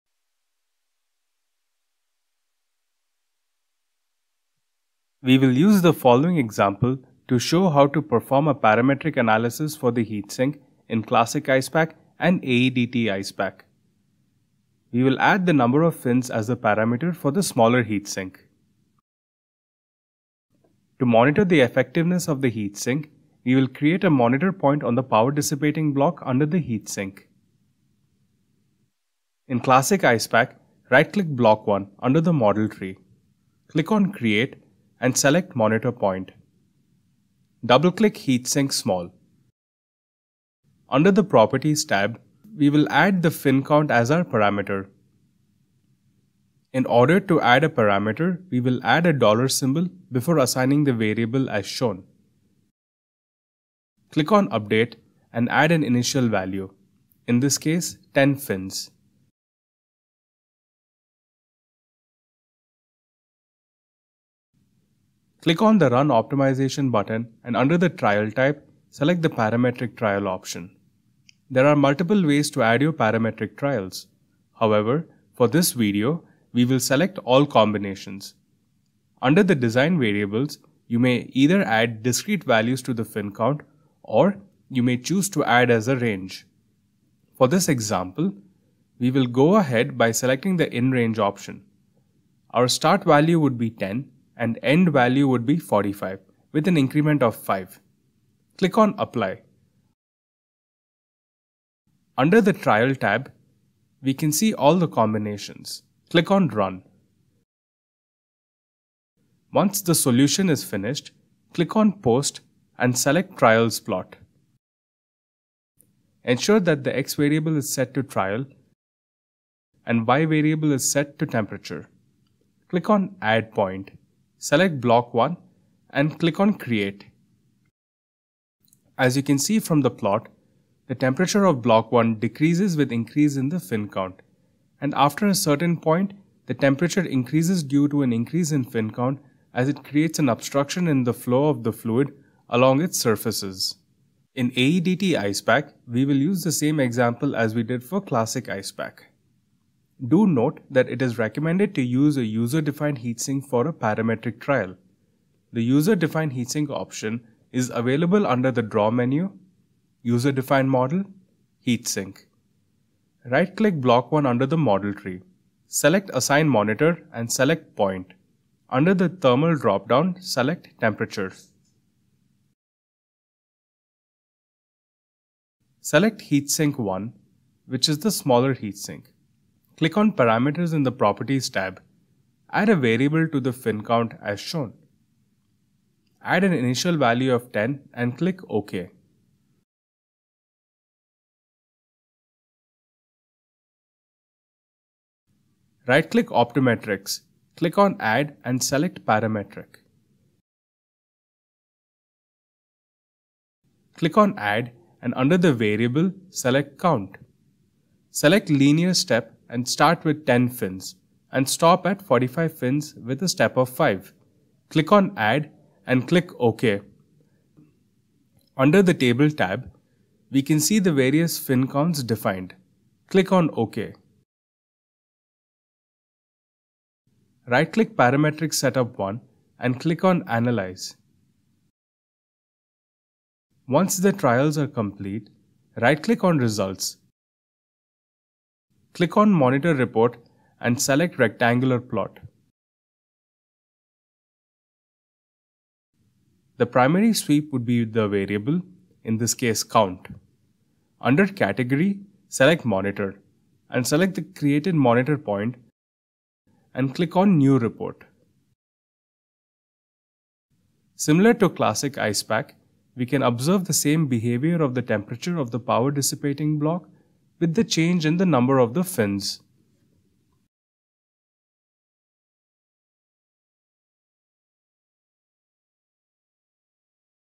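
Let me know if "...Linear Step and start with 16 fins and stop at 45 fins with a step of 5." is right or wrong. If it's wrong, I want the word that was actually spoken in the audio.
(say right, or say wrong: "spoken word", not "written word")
wrong: "10", not "16".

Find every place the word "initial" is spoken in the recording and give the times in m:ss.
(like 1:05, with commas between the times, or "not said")
0:55, 3:06.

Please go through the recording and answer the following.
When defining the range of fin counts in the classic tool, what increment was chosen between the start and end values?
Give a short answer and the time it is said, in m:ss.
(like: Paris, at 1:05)
5, at 1:36.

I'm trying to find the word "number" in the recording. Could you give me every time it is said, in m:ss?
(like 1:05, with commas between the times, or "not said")
0:15, 4:28.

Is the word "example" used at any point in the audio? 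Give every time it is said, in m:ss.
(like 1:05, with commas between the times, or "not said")
0:06, 1:27, 2:26.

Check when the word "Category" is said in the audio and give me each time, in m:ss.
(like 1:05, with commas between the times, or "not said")
4:11.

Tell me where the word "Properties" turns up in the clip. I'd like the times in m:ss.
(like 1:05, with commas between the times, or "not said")
0:41, 3:00.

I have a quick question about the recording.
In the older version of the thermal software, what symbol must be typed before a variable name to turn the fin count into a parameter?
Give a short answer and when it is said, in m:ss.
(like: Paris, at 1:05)
dollar symbol, at 0:49.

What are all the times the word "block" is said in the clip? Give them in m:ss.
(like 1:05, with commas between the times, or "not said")
0:25, 0:31, 2:04, 2:11, 2:43, 4:26.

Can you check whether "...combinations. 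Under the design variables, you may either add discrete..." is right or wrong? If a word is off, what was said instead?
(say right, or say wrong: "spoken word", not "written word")
right.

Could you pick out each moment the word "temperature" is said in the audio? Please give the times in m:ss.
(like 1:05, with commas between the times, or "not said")
2:01, 2:10, 2:16, 2:50, 4:24.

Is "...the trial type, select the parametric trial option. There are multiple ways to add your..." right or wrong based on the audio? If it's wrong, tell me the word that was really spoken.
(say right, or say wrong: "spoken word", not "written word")
right.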